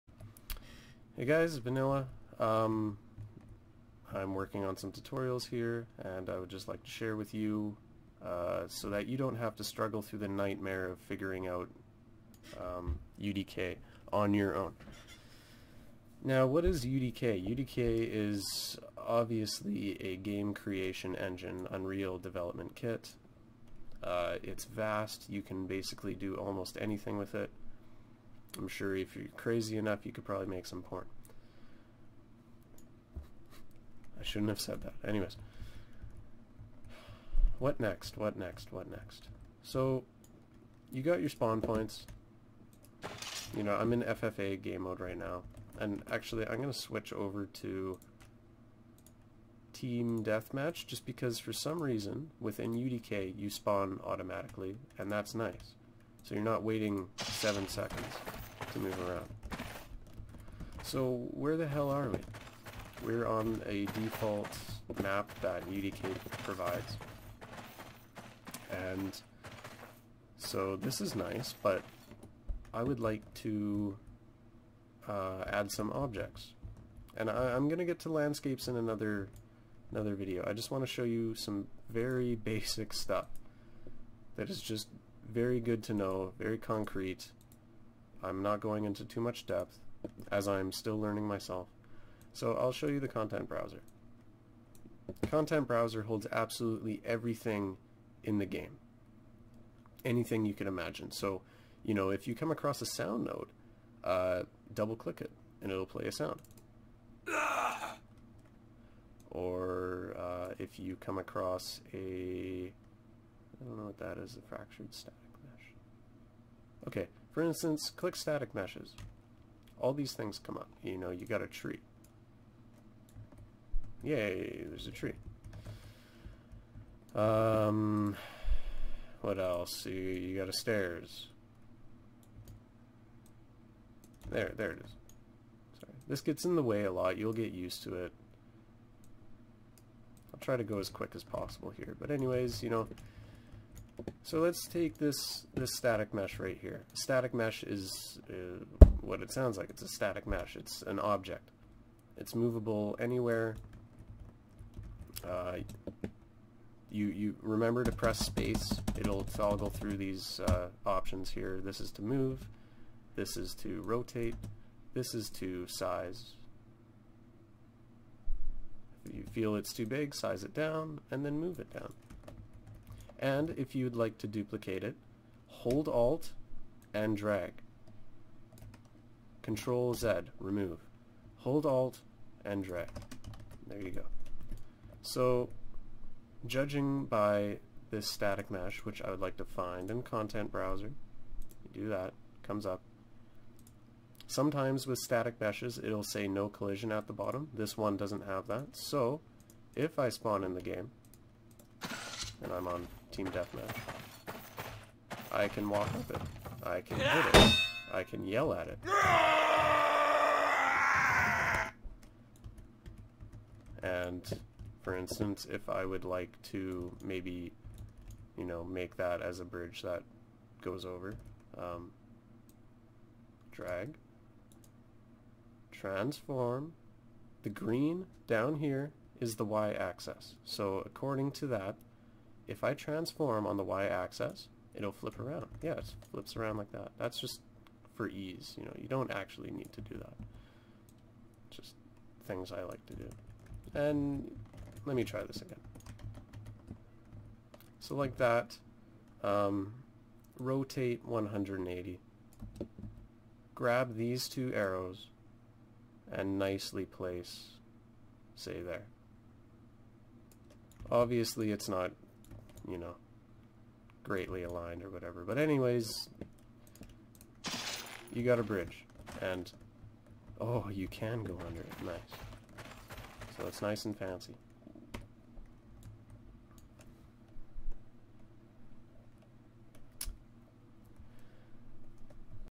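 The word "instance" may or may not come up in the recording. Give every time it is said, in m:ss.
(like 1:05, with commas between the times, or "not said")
1:57, 3:34.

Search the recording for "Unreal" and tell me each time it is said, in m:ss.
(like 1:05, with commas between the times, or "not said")
0:21.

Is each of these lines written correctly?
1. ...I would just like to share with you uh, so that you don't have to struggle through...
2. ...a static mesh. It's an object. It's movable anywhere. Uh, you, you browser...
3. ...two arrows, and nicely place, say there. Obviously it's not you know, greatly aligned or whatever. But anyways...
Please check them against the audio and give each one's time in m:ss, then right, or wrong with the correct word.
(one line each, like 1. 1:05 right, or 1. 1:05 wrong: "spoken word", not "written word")
1. 0:06 right
2. 2:29 wrong: "remember", not "browser"
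3. 4:14 right.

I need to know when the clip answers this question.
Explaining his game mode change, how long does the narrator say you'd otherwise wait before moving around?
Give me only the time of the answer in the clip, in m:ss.
0:57.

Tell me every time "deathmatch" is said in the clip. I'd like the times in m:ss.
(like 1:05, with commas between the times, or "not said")
0:50, 3:23.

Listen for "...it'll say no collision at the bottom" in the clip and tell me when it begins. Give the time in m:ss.
3:15.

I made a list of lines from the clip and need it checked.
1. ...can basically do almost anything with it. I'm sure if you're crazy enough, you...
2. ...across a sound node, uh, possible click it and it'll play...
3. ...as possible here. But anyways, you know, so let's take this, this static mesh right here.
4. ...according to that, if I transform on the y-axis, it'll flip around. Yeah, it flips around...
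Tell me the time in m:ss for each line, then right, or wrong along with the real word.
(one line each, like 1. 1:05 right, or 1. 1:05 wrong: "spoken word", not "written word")
1. 0:25 right
2. 1:42 wrong: "double", not "possible"
3. 2:21 right
4. 3:50 right.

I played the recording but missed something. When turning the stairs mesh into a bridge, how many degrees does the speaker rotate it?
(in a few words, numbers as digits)
180.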